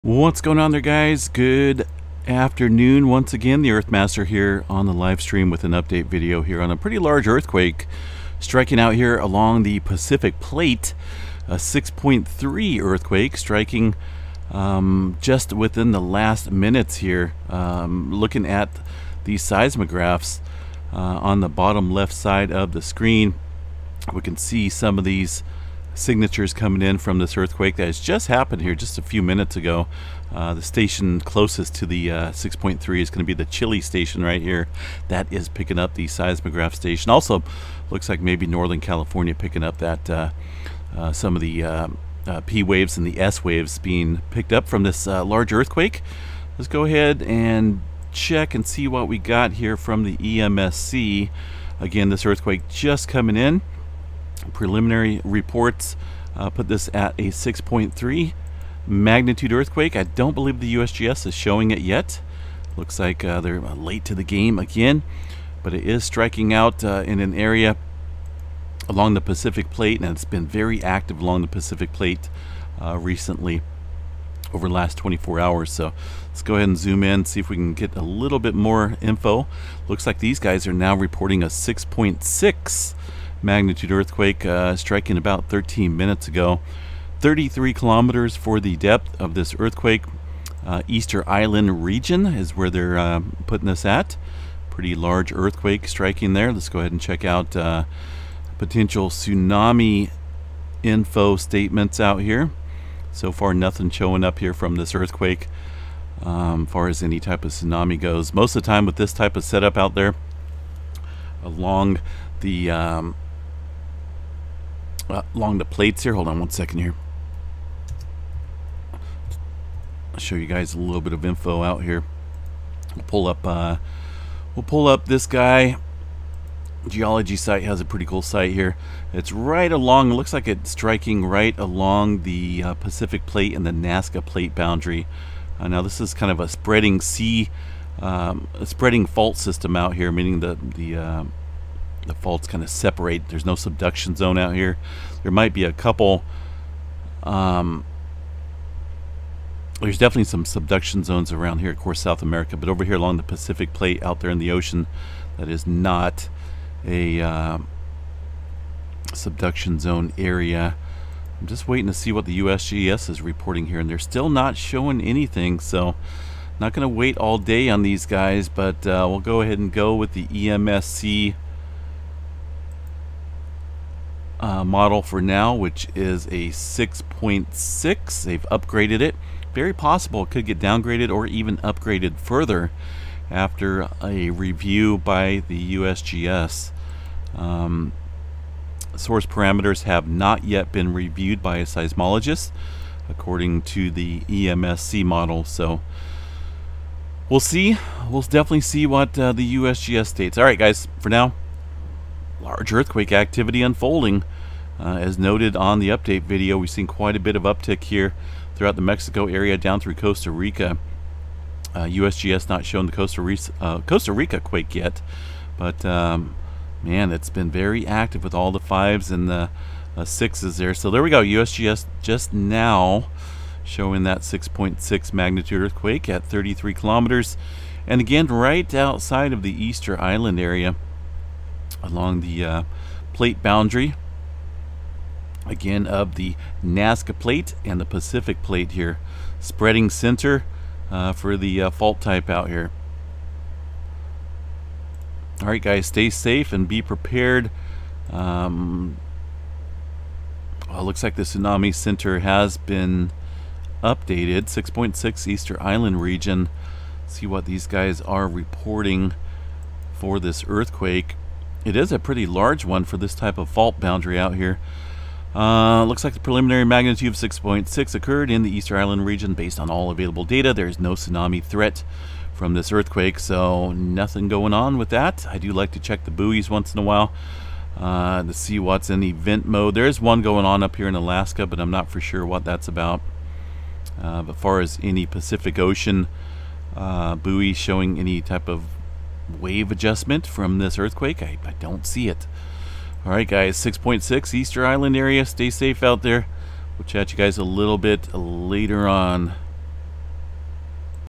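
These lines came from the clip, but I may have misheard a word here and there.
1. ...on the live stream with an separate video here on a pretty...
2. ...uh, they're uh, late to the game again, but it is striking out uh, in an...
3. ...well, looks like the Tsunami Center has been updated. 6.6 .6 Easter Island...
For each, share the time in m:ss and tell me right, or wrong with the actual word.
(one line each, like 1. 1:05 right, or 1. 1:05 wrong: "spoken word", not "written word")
1. 0:04 wrong: "update", not "separate"
2. 1:03 right
3. 4:10 right.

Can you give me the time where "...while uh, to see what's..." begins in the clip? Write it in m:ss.
4:36.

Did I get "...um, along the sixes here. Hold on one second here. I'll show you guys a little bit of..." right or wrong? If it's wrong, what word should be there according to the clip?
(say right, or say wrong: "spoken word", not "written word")
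wrong: "plates", not "sixes".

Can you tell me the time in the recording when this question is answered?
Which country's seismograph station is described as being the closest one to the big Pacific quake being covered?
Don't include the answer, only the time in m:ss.
0:33.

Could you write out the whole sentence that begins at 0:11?
A 6.3 earthquake striking um, just within the last minutes here.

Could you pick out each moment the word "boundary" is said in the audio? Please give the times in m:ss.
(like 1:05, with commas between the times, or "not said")
2:14, 3:53, 4:23.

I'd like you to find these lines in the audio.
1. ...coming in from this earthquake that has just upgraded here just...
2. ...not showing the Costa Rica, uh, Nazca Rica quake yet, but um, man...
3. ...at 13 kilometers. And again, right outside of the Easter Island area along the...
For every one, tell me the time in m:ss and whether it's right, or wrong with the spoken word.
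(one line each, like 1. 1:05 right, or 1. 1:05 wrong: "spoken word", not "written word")
1. 0:26 wrong: "happened", not "upgraded"
2. 3:32 wrong: "Costa", not "Nazca"
3. 3:46 wrong: "33", not "13".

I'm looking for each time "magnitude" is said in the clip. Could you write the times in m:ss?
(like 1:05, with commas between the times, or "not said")
0:58, 1:23, 3:45, 4:26.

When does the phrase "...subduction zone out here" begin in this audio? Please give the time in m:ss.
2:23.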